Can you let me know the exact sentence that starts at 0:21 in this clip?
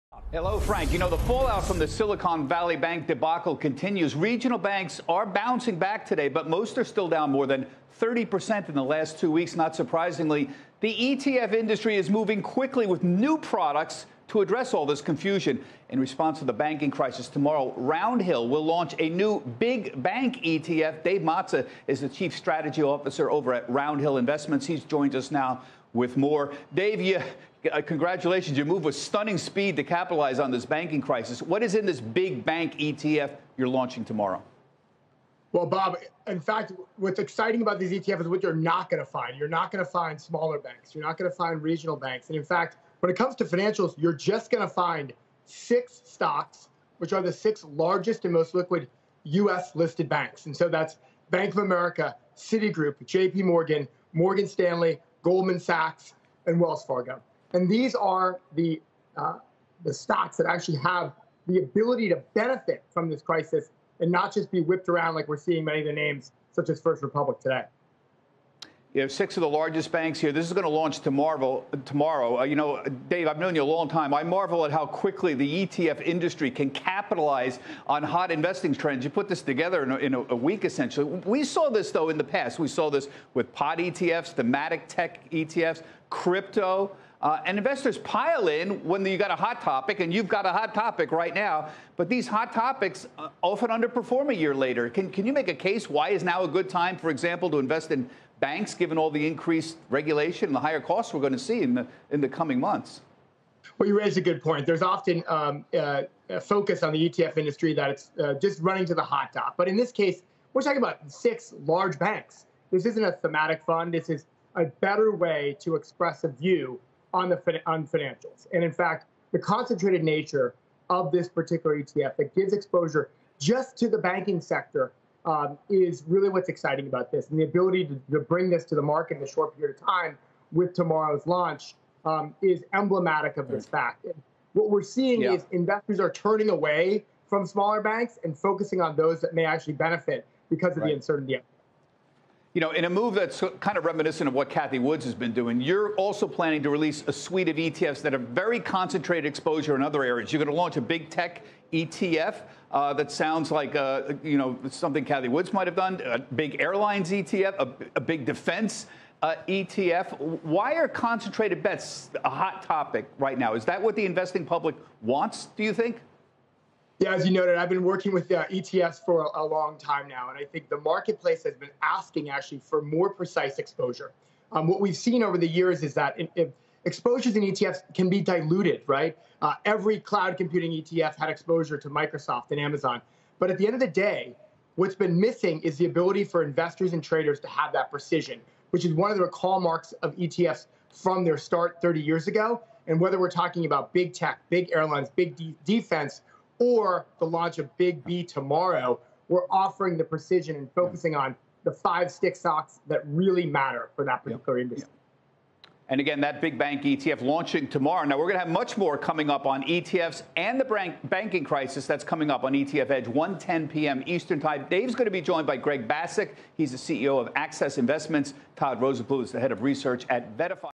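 Dave Mazza is the chief strategy officer over at Roundhill Investments.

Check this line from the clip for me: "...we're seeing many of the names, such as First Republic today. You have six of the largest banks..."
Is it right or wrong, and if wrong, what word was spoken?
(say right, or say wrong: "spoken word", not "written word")
right.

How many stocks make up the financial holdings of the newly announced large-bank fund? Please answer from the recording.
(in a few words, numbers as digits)
6.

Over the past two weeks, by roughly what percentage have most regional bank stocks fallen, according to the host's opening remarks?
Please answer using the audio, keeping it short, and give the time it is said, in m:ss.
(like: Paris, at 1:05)
more than 30%, at 0:07.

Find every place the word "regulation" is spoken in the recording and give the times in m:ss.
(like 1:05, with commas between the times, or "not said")
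1:39.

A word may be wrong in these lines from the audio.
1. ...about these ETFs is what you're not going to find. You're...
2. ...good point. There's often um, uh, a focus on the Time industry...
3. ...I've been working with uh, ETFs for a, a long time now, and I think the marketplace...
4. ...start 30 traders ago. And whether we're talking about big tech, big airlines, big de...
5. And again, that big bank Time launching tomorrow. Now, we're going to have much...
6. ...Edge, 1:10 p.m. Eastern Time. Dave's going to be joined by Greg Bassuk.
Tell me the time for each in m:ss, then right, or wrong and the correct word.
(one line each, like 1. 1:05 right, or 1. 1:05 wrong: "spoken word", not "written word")
1. 0:37 right
2. 1:44 wrong: "ETF", not "Time"
3. 2:47 right
4. 3:11 wrong: "years", not "traders"
5. 3:25 wrong: "ETF", not "Time"
6. 3:32 right.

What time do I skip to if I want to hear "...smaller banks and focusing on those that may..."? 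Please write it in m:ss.
2:17.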